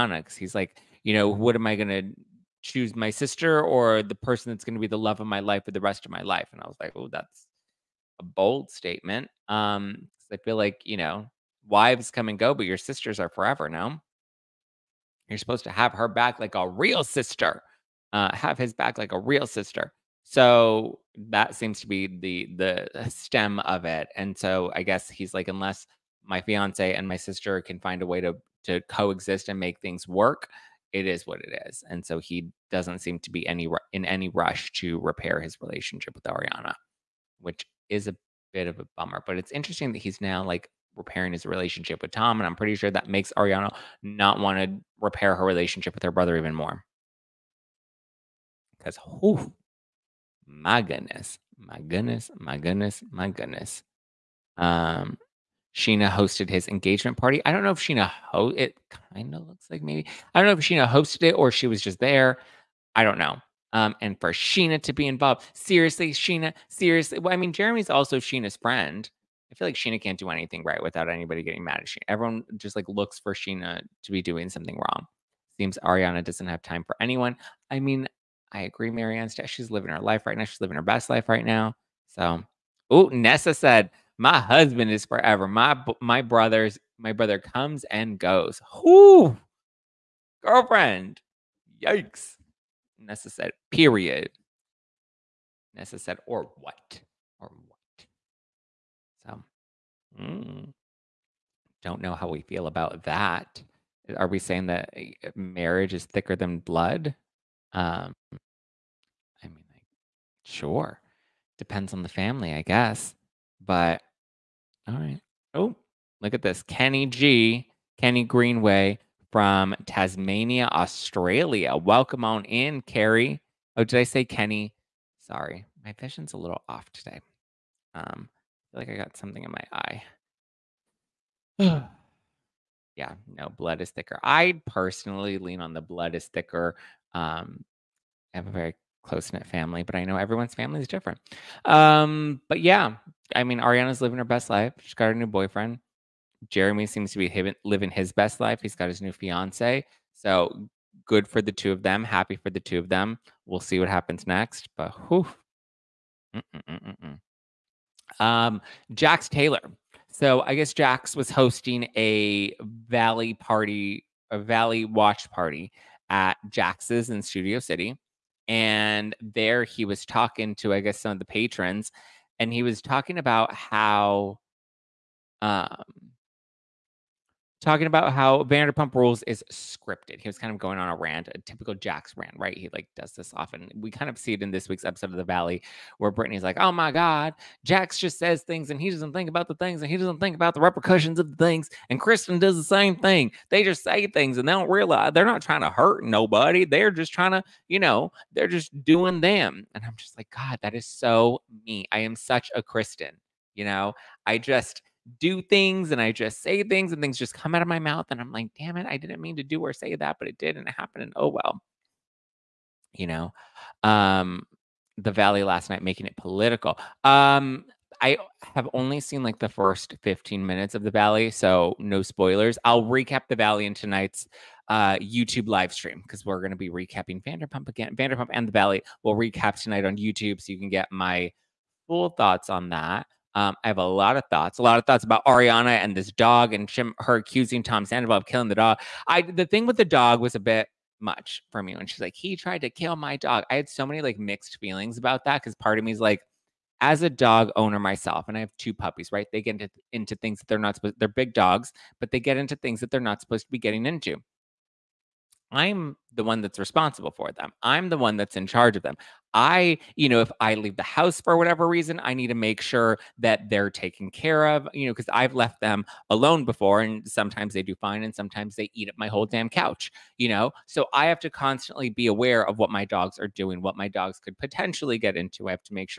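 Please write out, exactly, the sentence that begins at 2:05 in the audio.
Sorry, my vision's a little off today.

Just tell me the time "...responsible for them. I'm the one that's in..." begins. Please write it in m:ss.
4:16.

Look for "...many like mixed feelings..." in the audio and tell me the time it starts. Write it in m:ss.
4:03.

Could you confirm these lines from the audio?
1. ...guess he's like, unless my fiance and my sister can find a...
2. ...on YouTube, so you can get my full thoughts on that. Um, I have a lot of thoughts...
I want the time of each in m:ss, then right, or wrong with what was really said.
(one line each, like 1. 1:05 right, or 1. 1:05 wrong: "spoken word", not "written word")
1. 0:24 right
2. 3:49 right.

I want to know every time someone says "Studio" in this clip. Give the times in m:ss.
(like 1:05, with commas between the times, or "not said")
2:47.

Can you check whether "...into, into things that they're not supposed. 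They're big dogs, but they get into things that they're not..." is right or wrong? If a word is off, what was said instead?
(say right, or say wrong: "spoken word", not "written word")
right.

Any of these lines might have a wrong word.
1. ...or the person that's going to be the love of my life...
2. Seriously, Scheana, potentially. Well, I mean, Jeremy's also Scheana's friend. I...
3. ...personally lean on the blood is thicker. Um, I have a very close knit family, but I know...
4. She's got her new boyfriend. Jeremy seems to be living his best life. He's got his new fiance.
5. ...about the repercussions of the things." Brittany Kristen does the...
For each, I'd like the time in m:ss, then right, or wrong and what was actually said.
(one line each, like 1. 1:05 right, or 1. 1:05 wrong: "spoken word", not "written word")
1. 0:03 right
2. 1:05 wrong: "seriously", not "potentially"
3. 2:14 right
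4. 2:24 right
5. 3:10 wrong: "And", not "Brittany".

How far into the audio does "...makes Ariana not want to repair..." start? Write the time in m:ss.
0:43.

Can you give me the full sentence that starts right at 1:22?
So, oh, Nessa said, my husband is forever.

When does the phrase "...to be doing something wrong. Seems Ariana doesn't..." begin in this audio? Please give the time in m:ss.
1:14.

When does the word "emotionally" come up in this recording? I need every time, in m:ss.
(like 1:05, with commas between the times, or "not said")
not said.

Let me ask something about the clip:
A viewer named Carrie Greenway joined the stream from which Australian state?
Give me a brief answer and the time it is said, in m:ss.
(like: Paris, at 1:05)
Tasmania, at 1:59.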